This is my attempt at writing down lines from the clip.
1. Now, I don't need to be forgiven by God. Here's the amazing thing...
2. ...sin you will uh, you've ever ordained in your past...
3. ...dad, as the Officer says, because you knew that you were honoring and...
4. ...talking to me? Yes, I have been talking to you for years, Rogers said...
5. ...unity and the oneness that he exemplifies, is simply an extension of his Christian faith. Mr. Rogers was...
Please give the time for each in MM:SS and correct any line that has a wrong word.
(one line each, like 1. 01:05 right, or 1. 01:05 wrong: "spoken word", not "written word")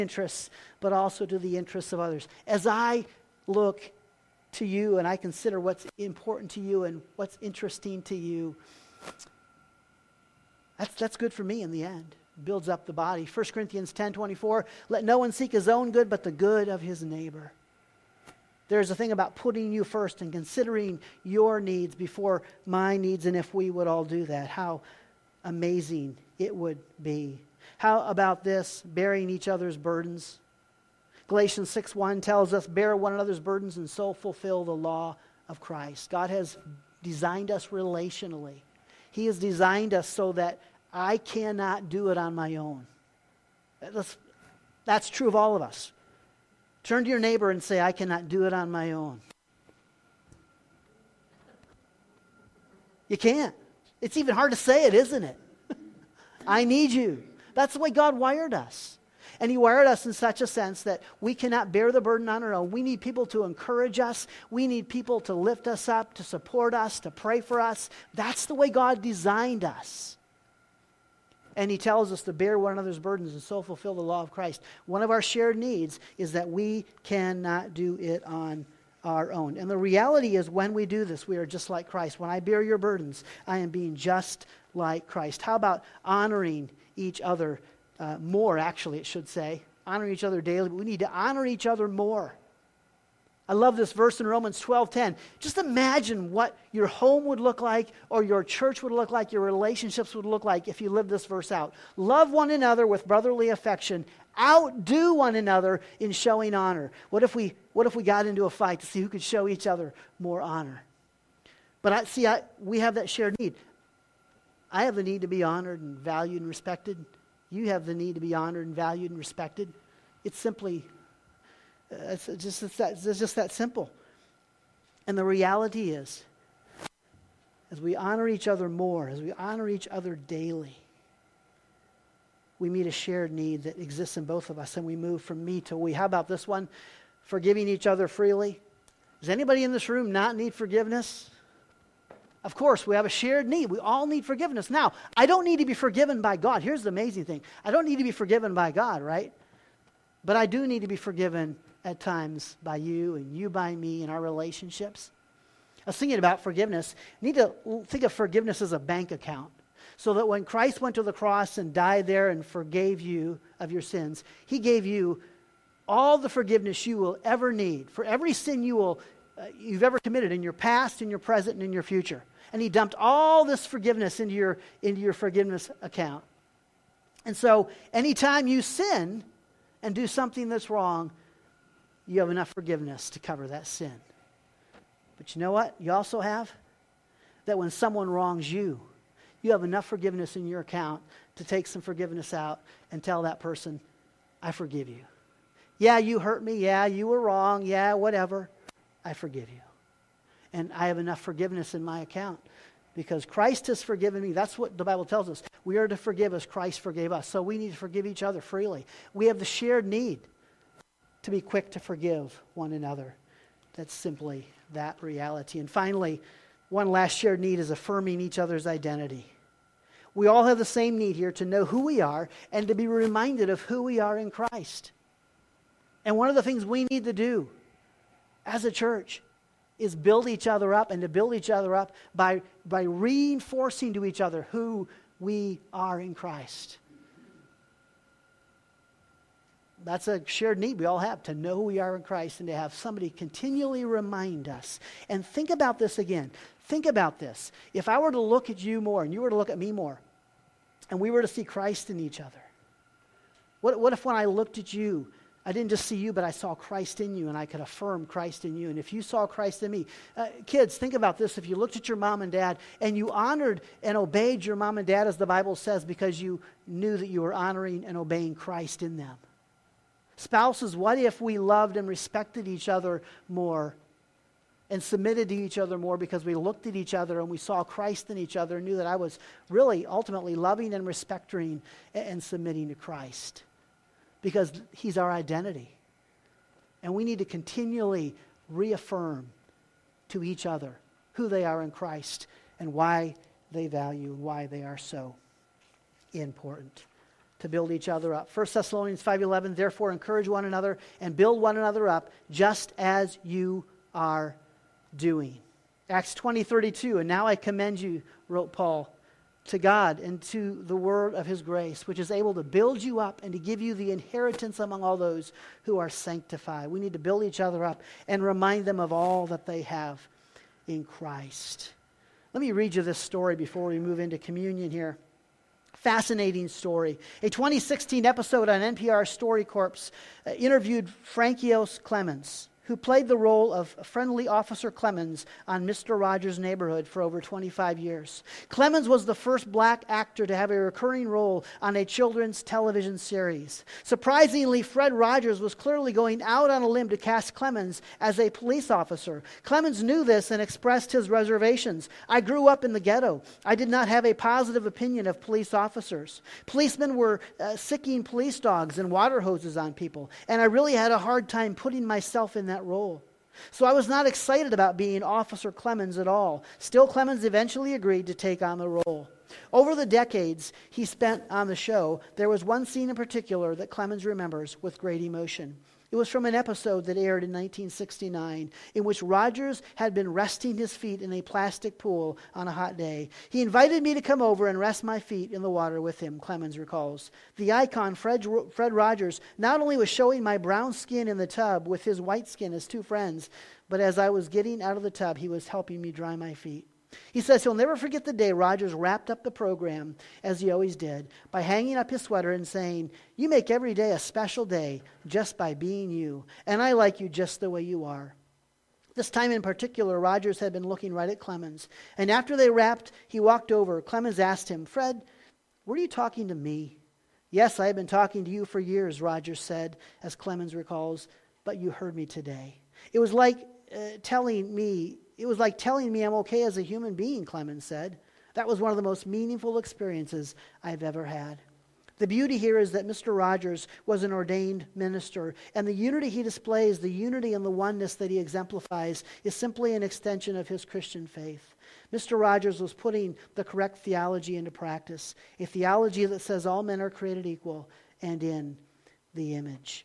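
1. 02:24 right
2. 02:48 wrong: "committed", not "ordained"
3. 04:24 wrong: "Bible", not "Officer"
4. 06:55 right
5. 07:16 right.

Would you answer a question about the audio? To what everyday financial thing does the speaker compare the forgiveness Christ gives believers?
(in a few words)
A bank account.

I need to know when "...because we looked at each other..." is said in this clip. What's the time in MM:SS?
04:35.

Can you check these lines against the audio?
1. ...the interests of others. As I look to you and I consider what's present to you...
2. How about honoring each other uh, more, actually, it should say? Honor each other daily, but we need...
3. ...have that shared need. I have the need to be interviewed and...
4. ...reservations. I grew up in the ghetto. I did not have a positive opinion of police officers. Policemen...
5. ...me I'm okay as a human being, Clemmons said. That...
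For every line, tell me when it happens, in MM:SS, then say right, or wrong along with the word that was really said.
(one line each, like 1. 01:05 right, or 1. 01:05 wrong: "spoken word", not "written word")
1. 00:01 wrong: "important", not "present"
2. 01:25 right
3. 01:52 wrong: "honored", not "interviewed"
4. 05:51 right
5. 07:05 right.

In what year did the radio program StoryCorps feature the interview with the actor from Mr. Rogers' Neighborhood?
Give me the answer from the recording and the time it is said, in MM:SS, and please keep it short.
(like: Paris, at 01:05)
2016, at 05:27.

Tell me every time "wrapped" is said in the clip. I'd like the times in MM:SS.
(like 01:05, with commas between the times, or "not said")
06:38, 06:52.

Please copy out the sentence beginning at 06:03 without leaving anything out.
So I was not excited about being Officer Clemmons at all.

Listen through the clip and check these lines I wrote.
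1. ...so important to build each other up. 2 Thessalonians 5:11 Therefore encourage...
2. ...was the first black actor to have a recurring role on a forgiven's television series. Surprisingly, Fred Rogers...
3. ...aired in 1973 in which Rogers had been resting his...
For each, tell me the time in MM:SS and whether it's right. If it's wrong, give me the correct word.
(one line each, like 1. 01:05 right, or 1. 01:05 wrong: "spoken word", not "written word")
1. 04:54 wrong: "1", not "2"
2. 05:38 wrong: "children", not "forgiven"
3. 06:16 wrong: "1969", not "1973".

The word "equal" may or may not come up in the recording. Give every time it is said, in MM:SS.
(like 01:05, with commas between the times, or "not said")
07:27.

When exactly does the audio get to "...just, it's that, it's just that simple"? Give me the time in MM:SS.
02:02.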